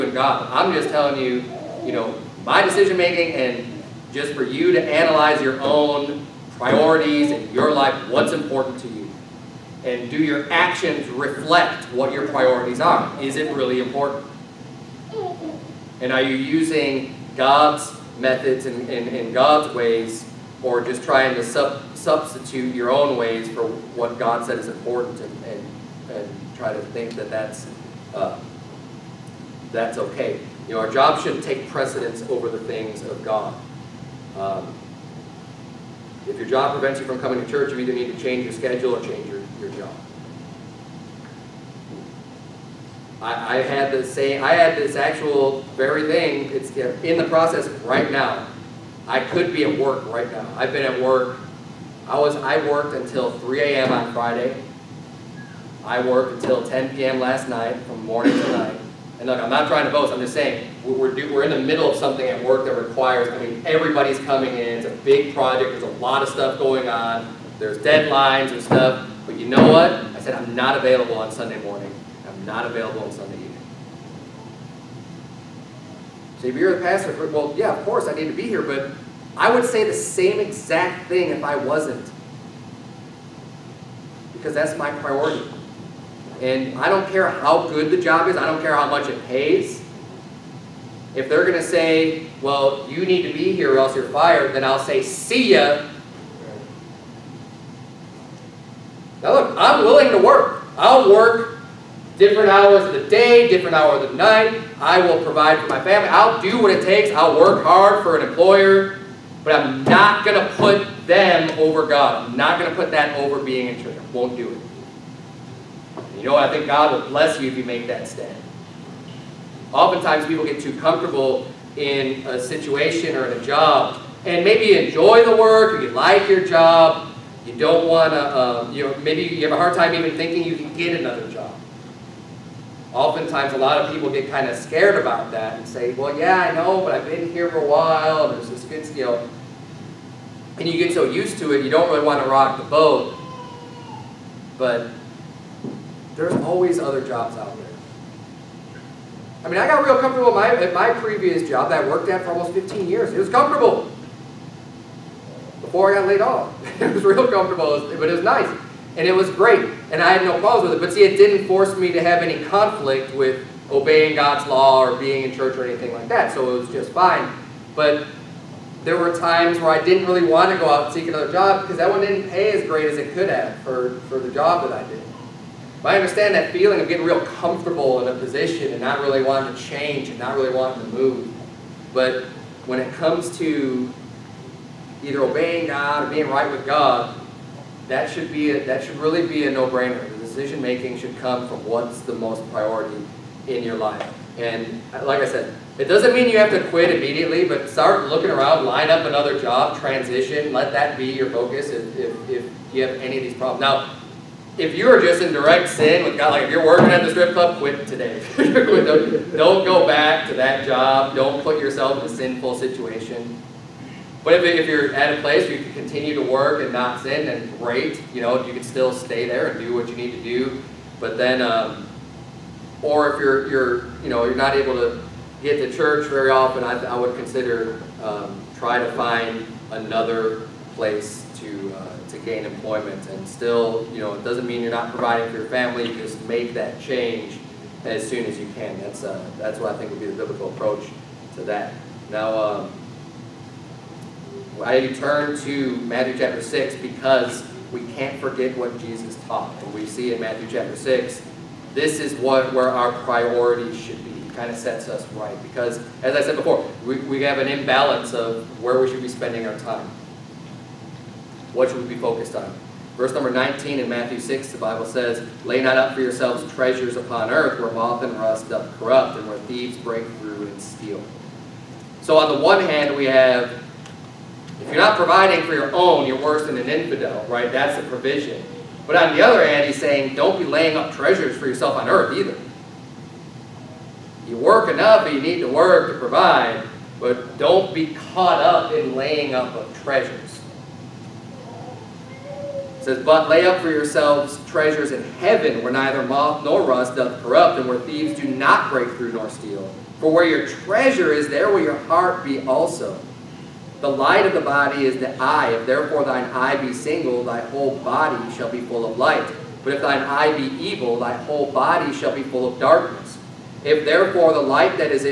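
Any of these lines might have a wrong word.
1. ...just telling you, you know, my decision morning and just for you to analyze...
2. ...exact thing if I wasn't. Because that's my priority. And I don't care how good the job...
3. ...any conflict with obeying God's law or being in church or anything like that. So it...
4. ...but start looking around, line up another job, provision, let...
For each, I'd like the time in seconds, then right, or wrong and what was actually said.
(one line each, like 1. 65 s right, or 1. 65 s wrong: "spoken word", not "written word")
1. 0 s wrong: "making", not "morning"
2. 80 s right
3. 162 s right
4. 197 s wrong: "transition", not "provision".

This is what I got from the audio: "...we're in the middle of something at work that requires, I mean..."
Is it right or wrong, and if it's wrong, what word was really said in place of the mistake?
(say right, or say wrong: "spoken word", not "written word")
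right.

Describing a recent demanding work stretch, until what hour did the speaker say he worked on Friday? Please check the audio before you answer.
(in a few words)
3 a.m.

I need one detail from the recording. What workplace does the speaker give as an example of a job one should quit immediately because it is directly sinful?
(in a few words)
strip club.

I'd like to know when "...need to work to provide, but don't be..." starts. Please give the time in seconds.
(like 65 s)
285 s.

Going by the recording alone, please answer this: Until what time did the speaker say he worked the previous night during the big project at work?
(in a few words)
10 p.m.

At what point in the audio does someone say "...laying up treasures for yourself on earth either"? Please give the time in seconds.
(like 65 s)
280 s.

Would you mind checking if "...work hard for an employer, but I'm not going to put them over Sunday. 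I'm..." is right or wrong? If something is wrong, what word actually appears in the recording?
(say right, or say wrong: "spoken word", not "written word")
wrong: "God", not "Sunday".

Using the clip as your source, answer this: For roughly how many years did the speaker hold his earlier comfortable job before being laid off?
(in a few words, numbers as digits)
15.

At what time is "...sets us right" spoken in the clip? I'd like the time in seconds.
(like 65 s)
254 s.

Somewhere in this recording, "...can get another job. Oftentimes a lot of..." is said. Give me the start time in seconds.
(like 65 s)
130 s.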